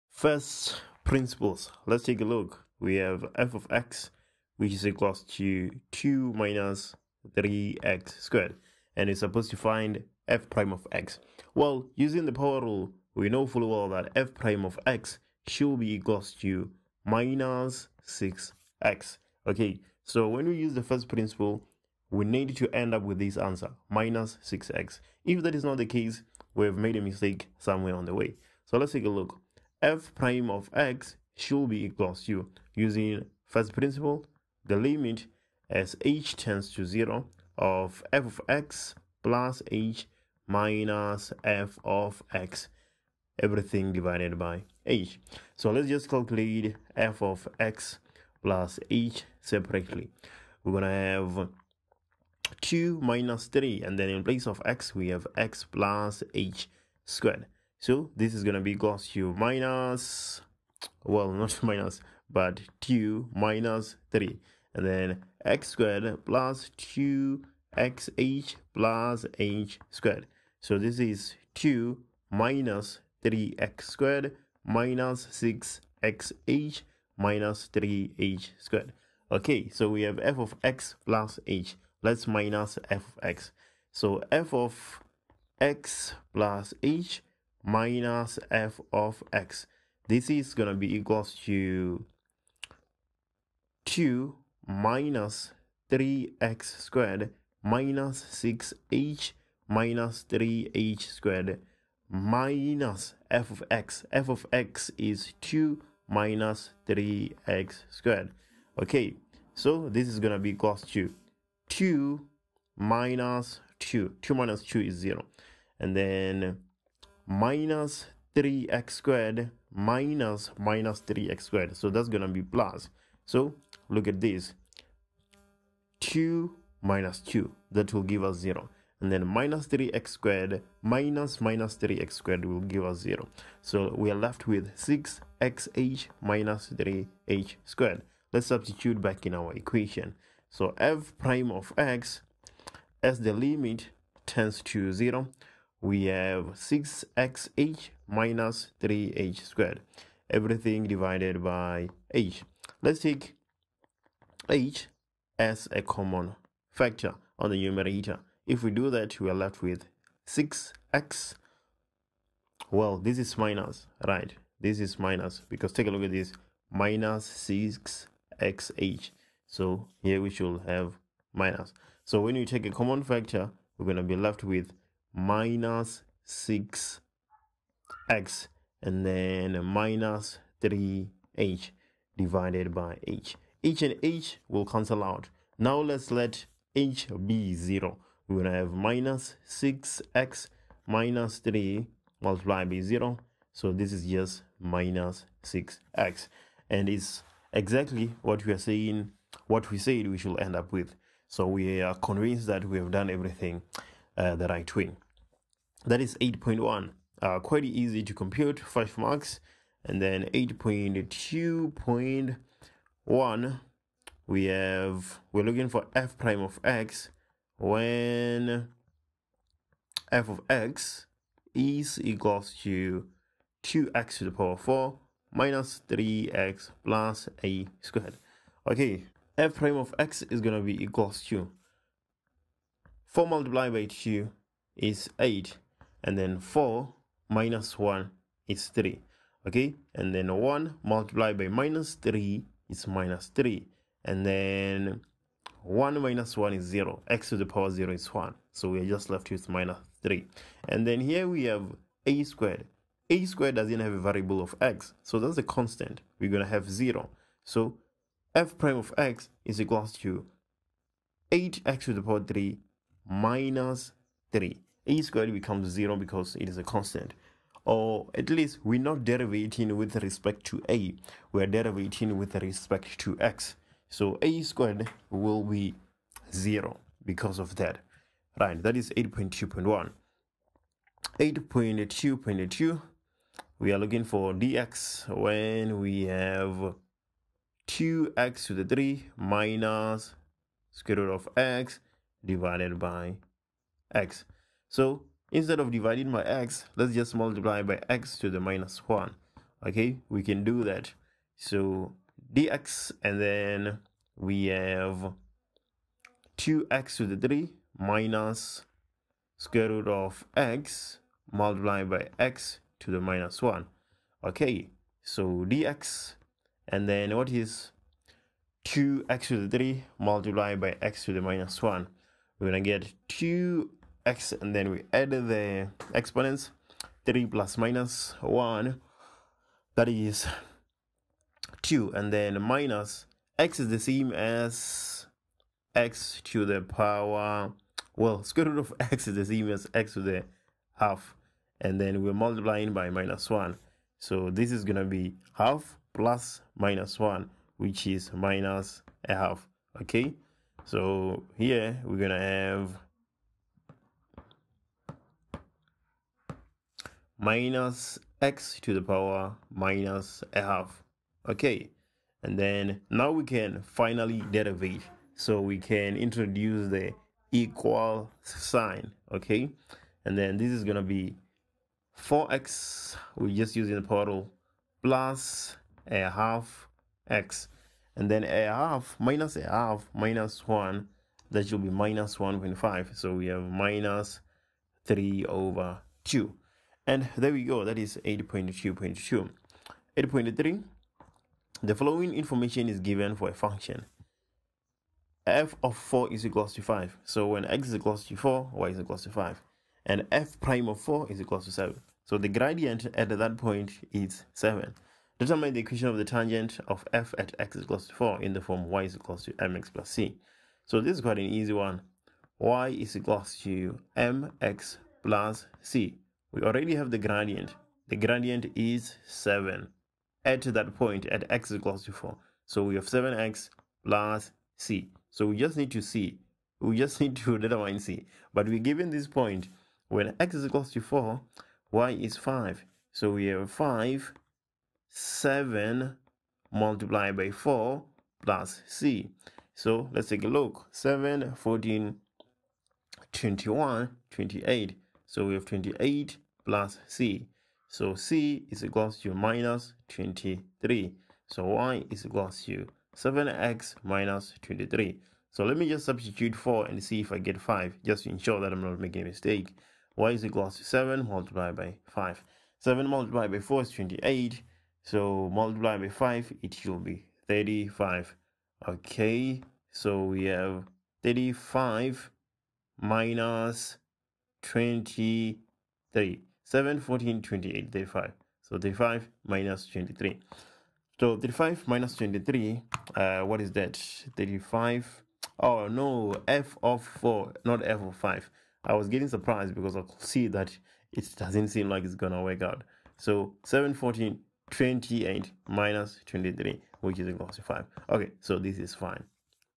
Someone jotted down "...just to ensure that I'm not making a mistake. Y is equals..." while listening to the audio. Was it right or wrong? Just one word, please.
right.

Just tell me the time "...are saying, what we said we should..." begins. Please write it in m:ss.
3:18.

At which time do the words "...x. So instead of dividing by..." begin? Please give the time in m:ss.
4:53.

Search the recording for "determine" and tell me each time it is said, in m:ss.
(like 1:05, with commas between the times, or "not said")
6:45, 7:07.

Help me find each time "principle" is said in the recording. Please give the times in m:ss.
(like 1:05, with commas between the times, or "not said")
0:01, 0:21, 0:33.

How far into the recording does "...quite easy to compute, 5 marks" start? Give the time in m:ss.
3:27.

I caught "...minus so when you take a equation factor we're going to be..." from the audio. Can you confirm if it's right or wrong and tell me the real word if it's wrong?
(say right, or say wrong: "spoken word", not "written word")
wrong: "common", not "equation".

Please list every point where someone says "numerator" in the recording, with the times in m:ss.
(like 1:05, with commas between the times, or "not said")
2:37.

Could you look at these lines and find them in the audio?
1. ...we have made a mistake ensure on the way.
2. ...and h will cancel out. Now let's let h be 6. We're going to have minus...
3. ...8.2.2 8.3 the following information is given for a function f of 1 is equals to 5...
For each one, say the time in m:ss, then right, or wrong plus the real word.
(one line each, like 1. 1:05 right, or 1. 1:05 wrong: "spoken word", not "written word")
1. 0:26 wrong: "somewhere", not "ensure"
2. 3:03 wrong: "0", not "6"
3. 6:28 wrong: "4", not "1".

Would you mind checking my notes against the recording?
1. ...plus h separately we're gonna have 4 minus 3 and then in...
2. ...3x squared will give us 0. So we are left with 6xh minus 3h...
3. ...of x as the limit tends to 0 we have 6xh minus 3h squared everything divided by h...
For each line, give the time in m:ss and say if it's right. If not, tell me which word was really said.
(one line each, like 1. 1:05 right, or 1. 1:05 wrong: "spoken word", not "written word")
1. 0:48 wrong: "2", not "4"
2. 2:11 right
3. 2:21 right.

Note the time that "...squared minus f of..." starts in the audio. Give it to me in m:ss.
1:41.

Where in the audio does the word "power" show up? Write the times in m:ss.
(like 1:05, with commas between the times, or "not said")
0:12, 3:44, 4:07, 4:22, 5:36, 5:58, 6:13.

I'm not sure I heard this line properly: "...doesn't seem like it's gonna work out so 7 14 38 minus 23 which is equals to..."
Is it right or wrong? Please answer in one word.
wrong.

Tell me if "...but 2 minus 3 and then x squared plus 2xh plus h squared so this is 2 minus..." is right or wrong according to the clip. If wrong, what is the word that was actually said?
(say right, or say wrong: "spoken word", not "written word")
right.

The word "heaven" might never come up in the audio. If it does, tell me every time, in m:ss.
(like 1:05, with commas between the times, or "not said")
not said.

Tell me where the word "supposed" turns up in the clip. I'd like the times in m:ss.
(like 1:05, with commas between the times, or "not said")
0:09.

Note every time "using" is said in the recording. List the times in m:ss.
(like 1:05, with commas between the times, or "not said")
0:11, 0:32, 6:13.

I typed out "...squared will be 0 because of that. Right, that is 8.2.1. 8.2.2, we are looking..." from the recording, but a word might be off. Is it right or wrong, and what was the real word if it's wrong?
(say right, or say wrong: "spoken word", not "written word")
right.